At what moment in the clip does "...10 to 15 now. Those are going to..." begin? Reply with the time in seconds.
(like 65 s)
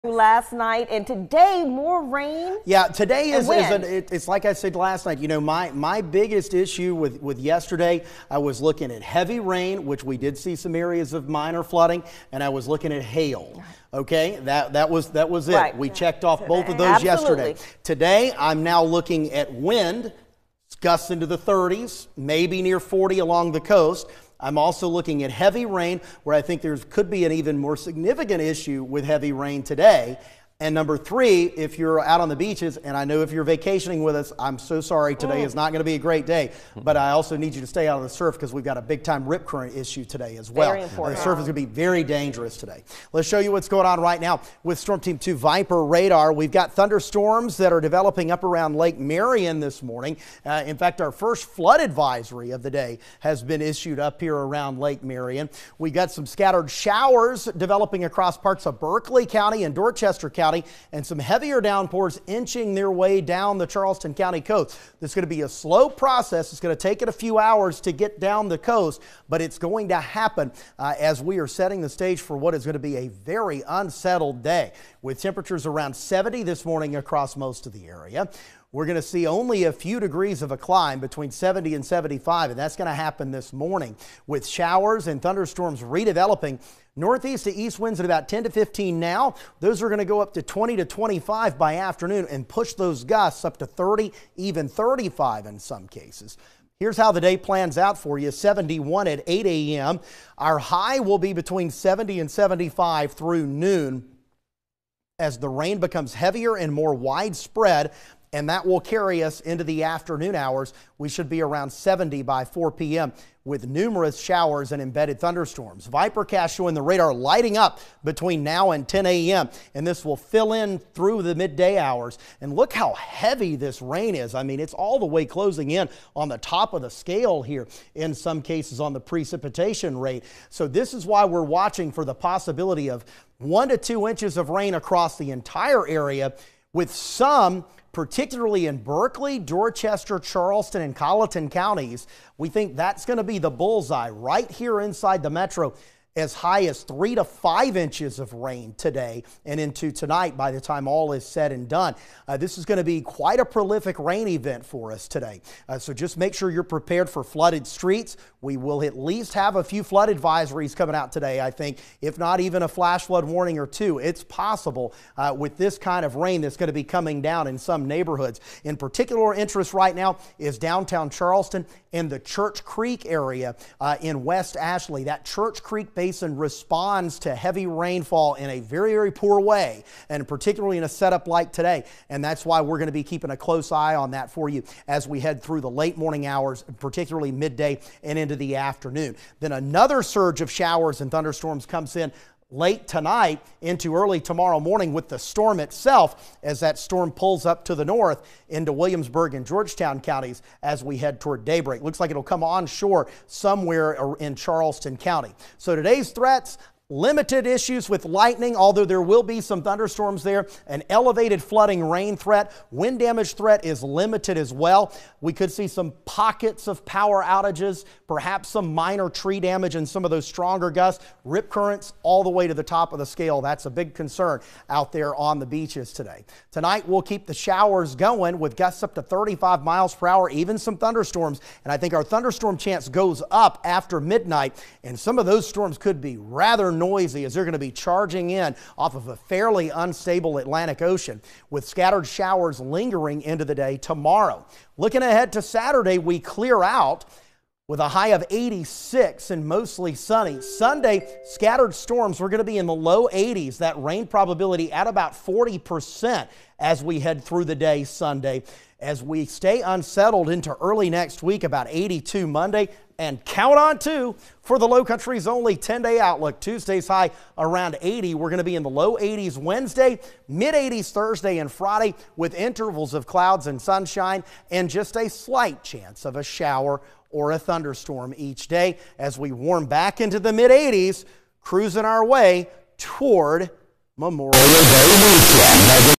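88 s.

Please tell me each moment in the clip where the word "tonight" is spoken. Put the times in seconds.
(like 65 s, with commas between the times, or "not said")
149 s, 192 s, 226 s.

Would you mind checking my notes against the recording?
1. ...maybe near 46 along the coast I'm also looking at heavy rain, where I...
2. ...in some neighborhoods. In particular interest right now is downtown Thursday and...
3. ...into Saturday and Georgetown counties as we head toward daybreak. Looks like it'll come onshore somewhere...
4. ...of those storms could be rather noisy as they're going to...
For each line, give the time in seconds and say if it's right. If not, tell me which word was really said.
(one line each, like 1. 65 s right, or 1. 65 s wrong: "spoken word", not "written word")
1. 22 s wrong: "40", not "46"
2. 167 s wrong: "Charleston", not "Thursday"
3. 198 s wrong: "Williamsburg", not "Saturday"
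4. 235 s right.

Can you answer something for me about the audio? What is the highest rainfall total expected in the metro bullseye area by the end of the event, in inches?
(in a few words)
3 to 5 inches.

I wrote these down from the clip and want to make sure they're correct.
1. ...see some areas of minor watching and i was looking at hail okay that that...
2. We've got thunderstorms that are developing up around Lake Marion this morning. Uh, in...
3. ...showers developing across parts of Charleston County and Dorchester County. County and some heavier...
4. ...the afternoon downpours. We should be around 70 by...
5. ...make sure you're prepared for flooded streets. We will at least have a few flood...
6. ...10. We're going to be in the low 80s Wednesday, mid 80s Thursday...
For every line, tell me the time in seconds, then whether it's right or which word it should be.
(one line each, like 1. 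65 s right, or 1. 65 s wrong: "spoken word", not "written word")
1. 10 s wrong: "flooding", not "watching"
2. 46 s right
3. 56 s wrong: "Berkeley", not "Charleston"
4. 109 s wrong: "hours", not "downpours"
5. 156 s right
6. 267 s wrong: "80", not "10".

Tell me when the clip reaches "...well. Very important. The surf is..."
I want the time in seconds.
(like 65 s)
40 s.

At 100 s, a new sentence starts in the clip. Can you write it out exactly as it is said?
Our high will be between 70 and 75 through noon.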